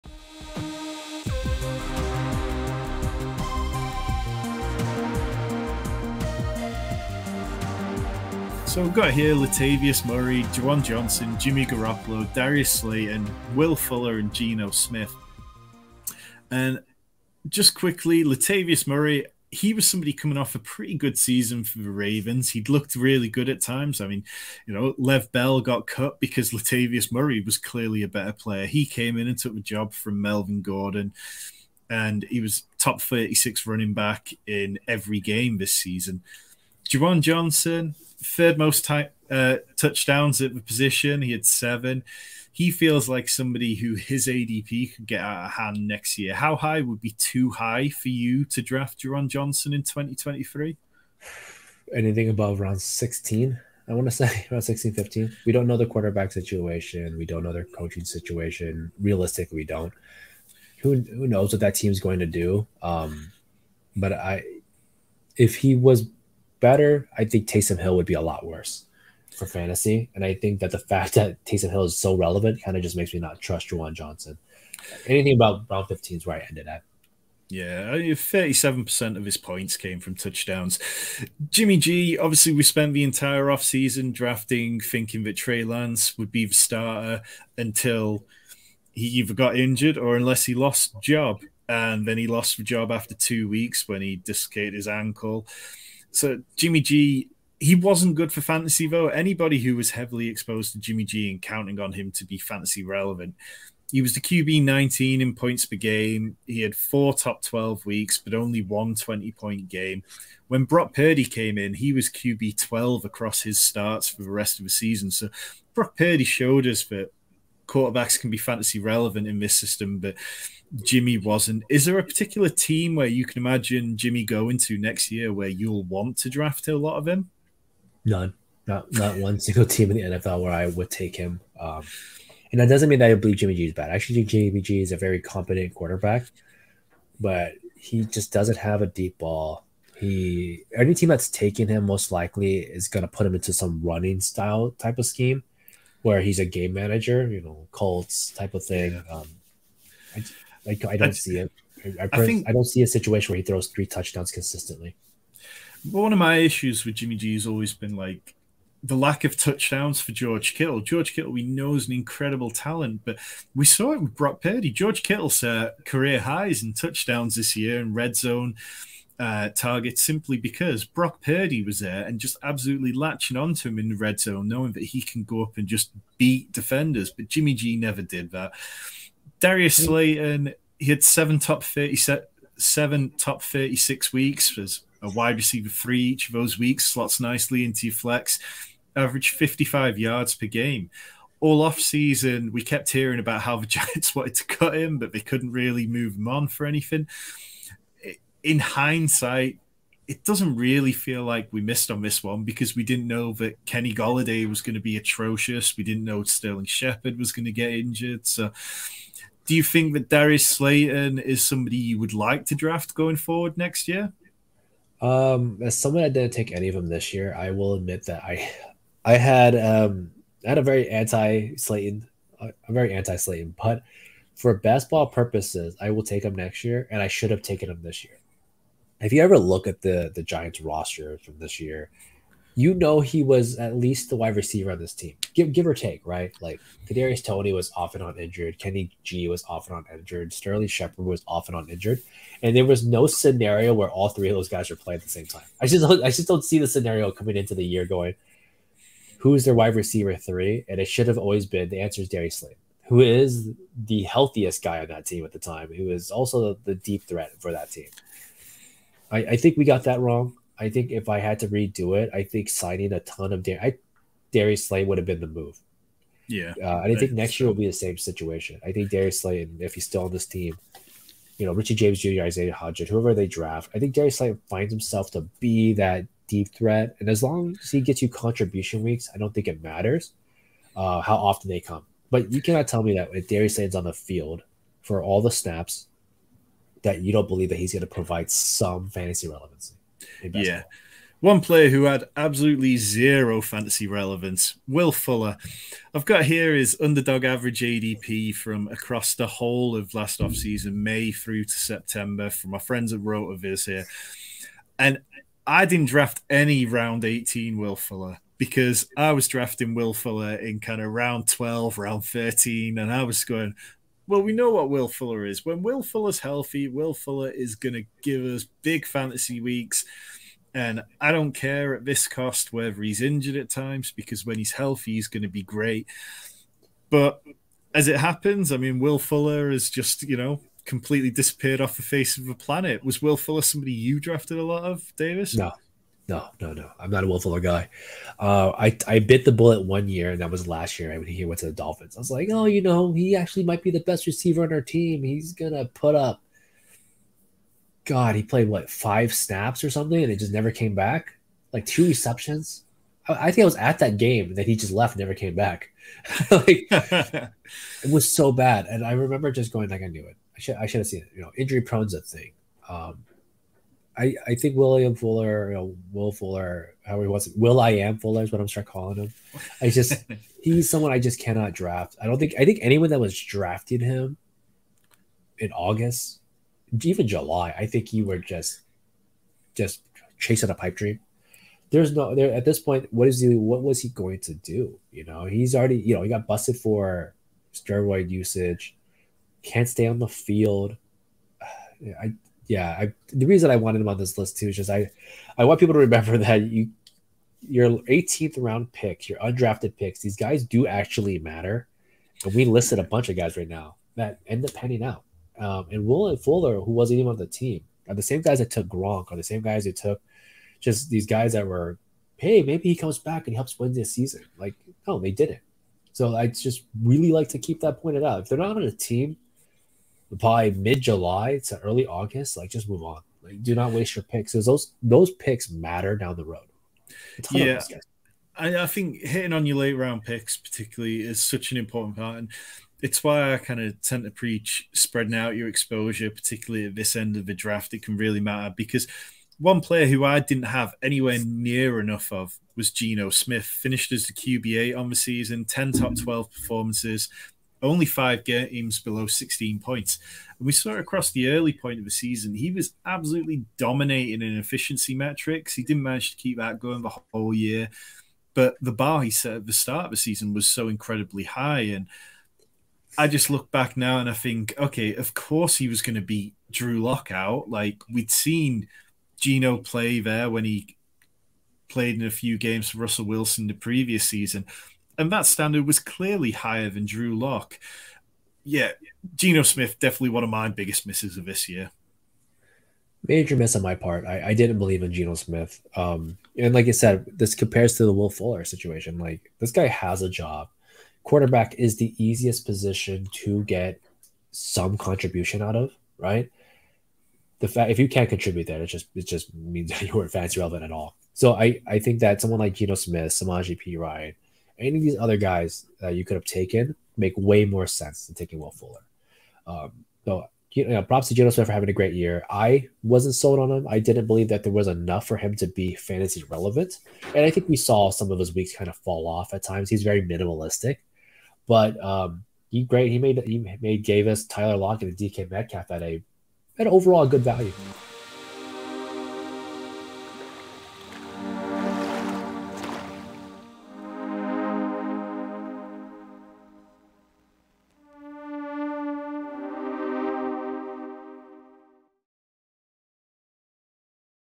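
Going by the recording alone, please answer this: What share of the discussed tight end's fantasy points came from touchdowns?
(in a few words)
37%.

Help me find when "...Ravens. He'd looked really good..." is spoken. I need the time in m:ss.
0:21.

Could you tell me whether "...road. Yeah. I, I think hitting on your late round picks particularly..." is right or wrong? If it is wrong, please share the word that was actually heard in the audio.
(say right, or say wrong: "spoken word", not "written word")
right.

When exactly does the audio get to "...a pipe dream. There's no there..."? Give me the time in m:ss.
6:20.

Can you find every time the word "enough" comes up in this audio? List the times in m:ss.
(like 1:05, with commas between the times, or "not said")
7:21, 8:34.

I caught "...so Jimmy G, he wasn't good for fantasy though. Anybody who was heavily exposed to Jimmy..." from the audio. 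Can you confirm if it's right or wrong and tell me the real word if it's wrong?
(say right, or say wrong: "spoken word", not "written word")
right.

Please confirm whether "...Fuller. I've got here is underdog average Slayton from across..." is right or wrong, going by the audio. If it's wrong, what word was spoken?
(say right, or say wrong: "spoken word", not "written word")
wrong: "ADP", not "Slayton".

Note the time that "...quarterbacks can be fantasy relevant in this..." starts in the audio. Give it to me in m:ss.
1:57.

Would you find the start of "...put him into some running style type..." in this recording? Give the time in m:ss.
2:23.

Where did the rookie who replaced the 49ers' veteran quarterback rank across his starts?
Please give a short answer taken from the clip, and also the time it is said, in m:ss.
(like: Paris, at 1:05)
QB12, at 1:52.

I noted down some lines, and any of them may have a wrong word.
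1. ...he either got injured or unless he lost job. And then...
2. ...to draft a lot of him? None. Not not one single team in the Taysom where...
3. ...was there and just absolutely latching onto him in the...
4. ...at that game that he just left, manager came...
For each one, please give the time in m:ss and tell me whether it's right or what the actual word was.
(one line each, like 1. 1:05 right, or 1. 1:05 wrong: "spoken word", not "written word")
1. 1:28 right
2. 2:06 wrong: "NFL", not "Taysom"
3. 2:51 right
4. 5:53 wrong: "never", not "manager".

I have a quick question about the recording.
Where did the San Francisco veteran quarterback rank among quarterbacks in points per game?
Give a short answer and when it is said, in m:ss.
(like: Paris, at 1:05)
QB19, at 1:44.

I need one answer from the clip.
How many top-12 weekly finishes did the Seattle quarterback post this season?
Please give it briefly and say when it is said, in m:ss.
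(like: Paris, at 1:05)
10, at 7:25.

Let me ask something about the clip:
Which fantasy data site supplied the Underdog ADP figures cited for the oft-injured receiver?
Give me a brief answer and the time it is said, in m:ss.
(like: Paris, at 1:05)
RotoViz, at 5:03.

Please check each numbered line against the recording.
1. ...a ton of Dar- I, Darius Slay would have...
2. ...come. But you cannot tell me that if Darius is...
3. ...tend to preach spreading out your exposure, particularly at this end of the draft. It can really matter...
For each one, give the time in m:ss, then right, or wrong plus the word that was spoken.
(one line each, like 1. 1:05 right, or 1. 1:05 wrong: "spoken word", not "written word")
1. 4:22 right
2. 4:41 right
3. 7:13 right.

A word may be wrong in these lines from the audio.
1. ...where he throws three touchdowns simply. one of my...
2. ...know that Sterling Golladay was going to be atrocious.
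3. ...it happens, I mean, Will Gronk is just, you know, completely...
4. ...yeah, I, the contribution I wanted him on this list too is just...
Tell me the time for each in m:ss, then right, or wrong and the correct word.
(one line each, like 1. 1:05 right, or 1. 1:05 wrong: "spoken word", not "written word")
1. 2:33 wrong: "consistently", not "simply"
2. 3:23 wrong: "Kenny", not "Sterling"
3. 5:27 wrong: "Fuller", not "Gronk"
4. 6:32 wrong: "reason", not "contribution".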